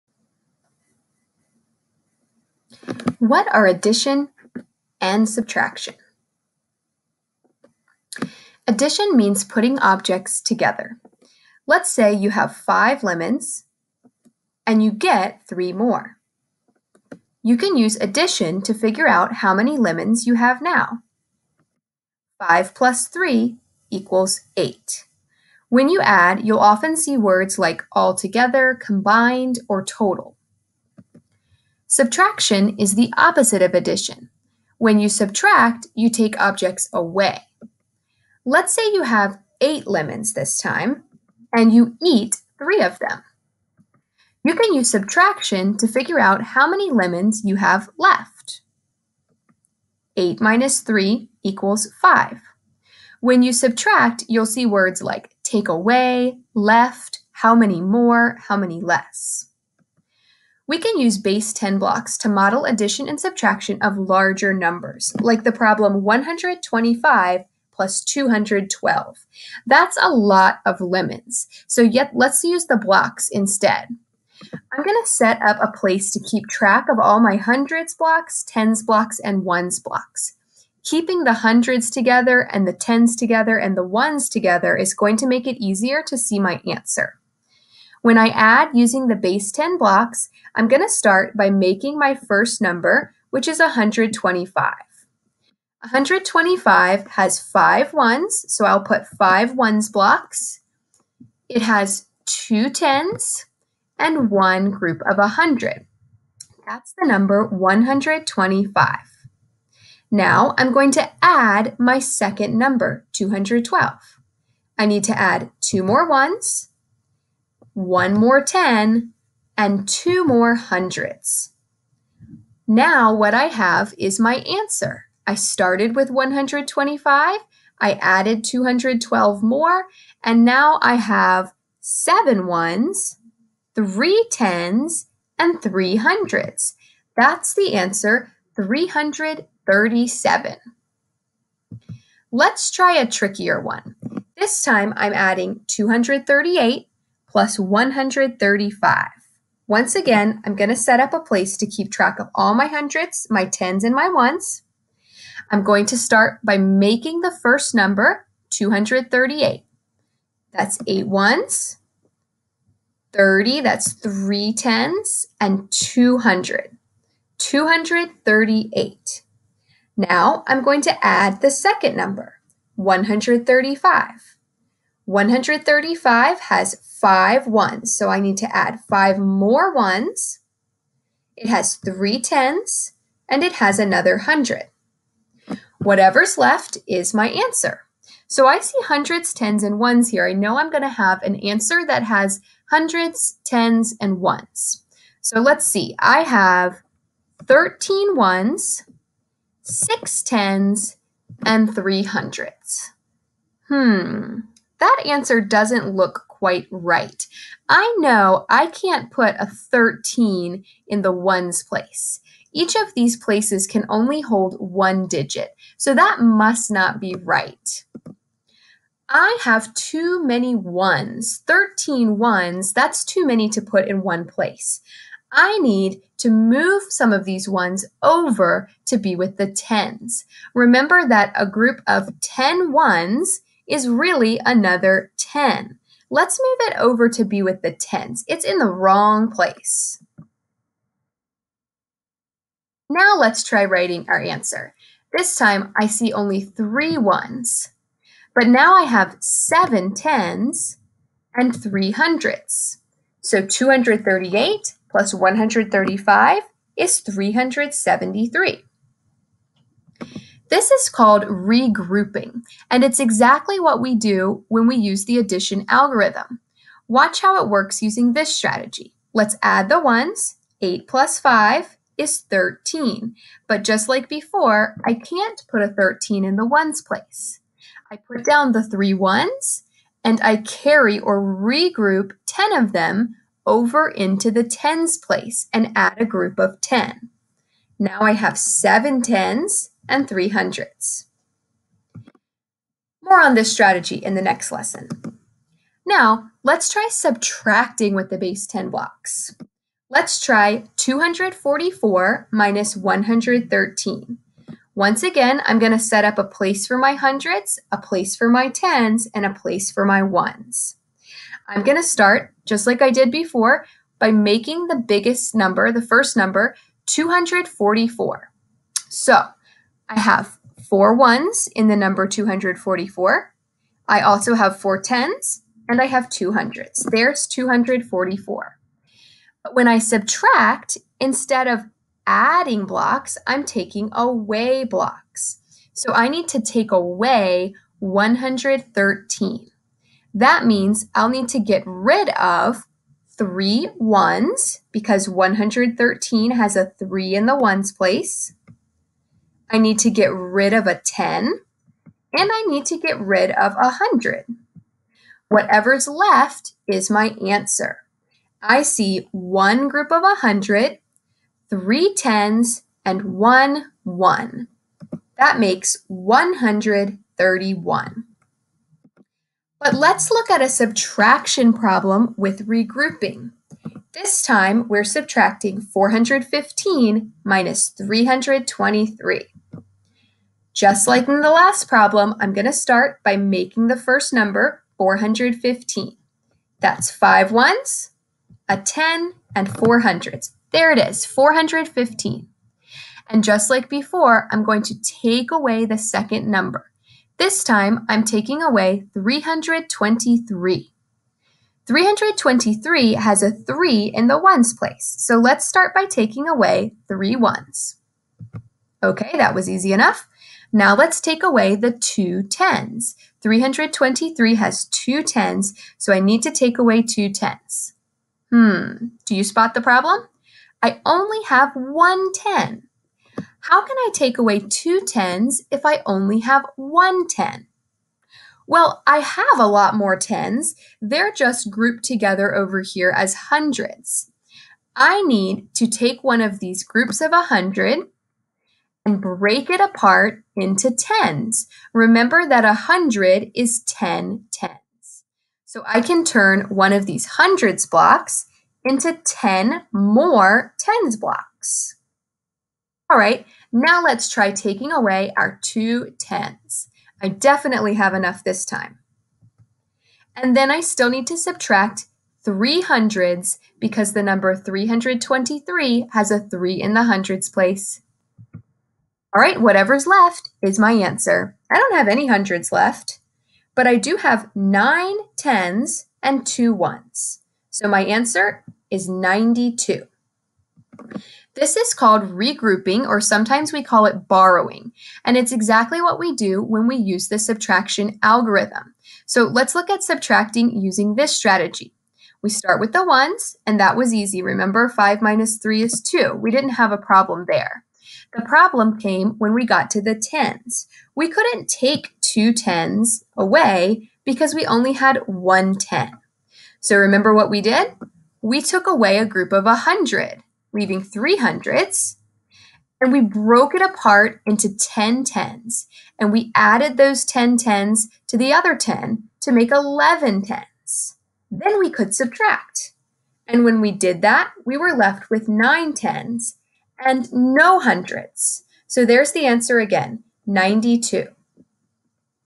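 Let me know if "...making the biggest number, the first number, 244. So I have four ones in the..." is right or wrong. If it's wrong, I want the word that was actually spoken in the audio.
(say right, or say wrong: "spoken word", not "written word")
right.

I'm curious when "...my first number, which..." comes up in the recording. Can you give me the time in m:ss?
1:31.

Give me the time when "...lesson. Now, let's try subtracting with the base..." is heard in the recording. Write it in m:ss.
4:54.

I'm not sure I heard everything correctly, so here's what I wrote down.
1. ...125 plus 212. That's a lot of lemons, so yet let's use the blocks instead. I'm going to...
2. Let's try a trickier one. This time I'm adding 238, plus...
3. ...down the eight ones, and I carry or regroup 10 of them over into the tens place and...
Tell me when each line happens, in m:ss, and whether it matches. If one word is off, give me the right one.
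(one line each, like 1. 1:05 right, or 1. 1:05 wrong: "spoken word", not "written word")
1. 1:06 right
2. 2:22 right
3. 4:38 wrong: "three", not "eight".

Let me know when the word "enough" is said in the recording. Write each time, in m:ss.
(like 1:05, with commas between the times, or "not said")
6:49, 7:37.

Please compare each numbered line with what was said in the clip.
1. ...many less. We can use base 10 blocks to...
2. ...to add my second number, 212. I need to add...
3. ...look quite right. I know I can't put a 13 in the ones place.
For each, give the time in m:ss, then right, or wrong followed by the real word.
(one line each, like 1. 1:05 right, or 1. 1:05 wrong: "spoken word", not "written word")
1. 0:58 right
2. 1:50 right
3. 3:25 right.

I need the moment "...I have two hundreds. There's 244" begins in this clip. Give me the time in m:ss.
5:25.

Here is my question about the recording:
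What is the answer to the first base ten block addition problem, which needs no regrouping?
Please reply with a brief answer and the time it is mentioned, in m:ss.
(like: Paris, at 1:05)
337, at 2:18.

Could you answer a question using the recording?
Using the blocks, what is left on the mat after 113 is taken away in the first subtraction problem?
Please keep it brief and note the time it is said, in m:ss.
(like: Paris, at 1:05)
131, at 6:05.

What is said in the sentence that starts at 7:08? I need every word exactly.
Well, I have a lot more tens.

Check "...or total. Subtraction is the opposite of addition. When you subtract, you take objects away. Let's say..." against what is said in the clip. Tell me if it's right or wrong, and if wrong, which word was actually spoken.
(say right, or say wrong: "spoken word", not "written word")
right.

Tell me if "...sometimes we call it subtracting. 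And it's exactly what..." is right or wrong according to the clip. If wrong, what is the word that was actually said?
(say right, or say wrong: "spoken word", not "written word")
wrong: "borrowing", not "subtracting".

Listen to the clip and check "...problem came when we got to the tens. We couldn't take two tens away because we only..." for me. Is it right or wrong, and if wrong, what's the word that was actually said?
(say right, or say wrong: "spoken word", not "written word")
right.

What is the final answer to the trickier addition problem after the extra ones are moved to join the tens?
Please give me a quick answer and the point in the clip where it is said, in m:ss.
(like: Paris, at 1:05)
373, at 4:16.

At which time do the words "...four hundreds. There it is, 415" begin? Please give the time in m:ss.
6:29.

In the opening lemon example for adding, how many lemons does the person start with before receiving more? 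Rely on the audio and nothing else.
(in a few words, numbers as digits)
5.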